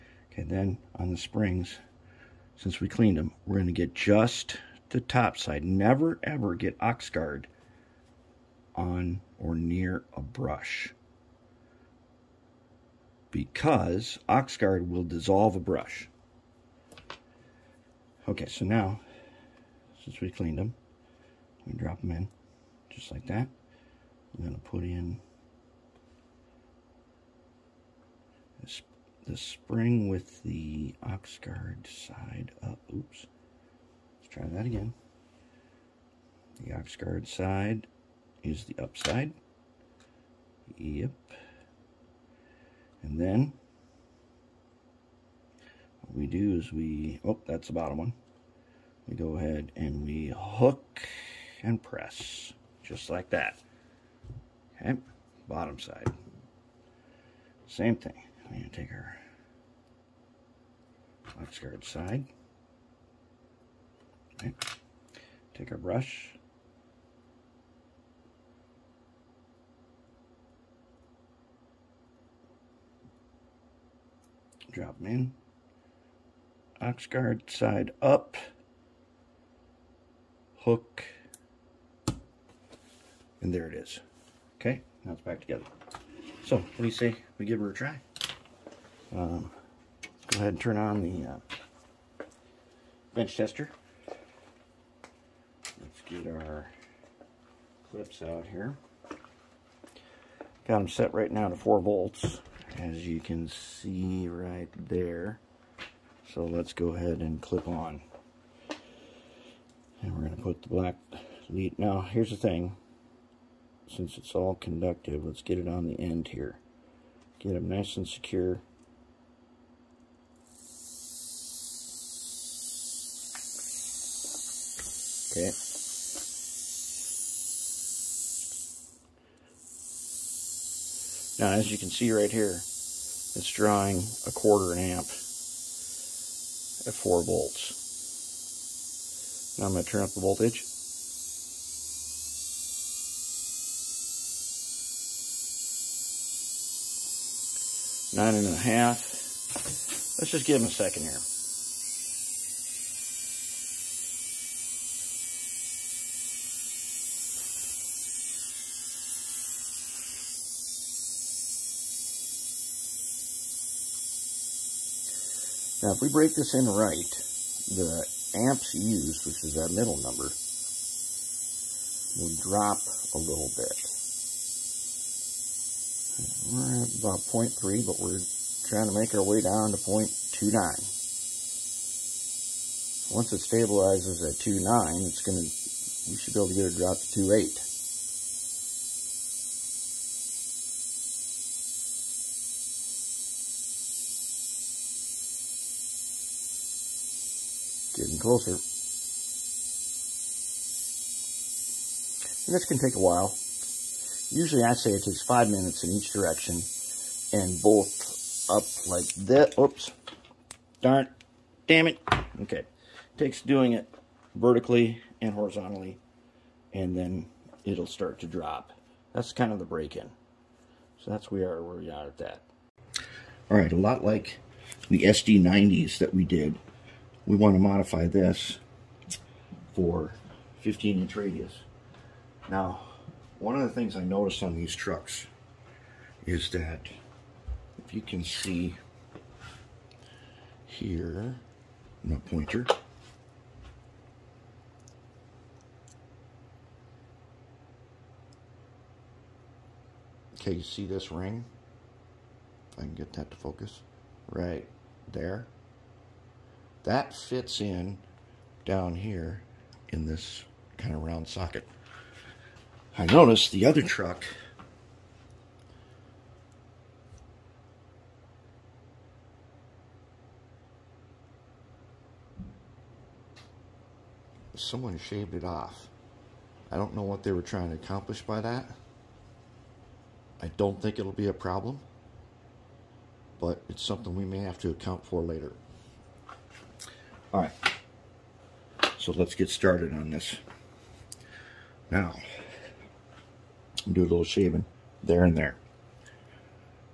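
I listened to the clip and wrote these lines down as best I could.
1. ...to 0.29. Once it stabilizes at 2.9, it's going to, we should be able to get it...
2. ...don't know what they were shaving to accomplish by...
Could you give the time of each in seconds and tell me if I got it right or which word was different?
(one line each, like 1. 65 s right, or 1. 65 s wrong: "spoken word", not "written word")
1. 179 s right
2. 276 s wrong: "trying", not "shaving".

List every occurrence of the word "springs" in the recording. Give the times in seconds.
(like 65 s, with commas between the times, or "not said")
1 s, 29 s.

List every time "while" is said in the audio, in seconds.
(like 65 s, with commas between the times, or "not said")
202 s.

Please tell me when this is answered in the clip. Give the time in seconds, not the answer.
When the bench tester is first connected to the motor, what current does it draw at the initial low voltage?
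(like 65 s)
134 s.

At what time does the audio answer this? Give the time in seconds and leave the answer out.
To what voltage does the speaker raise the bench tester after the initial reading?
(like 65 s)
148 s.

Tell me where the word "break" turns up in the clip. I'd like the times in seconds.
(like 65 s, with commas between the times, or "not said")
166 s, 219 s.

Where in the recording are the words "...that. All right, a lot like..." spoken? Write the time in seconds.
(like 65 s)
222 s.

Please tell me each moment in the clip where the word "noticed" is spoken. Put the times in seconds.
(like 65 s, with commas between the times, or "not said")
234 s, 263 s.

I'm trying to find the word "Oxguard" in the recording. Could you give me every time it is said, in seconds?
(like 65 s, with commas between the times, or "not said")
14 s, 31 s, 36 s, 76 s.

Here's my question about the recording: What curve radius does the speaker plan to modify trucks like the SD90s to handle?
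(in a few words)
15 inch.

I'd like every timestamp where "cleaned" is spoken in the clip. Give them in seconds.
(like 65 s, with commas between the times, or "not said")
2 s, 20 s.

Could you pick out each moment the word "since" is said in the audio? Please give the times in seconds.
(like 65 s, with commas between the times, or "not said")
2 s, 20 s, 113 s.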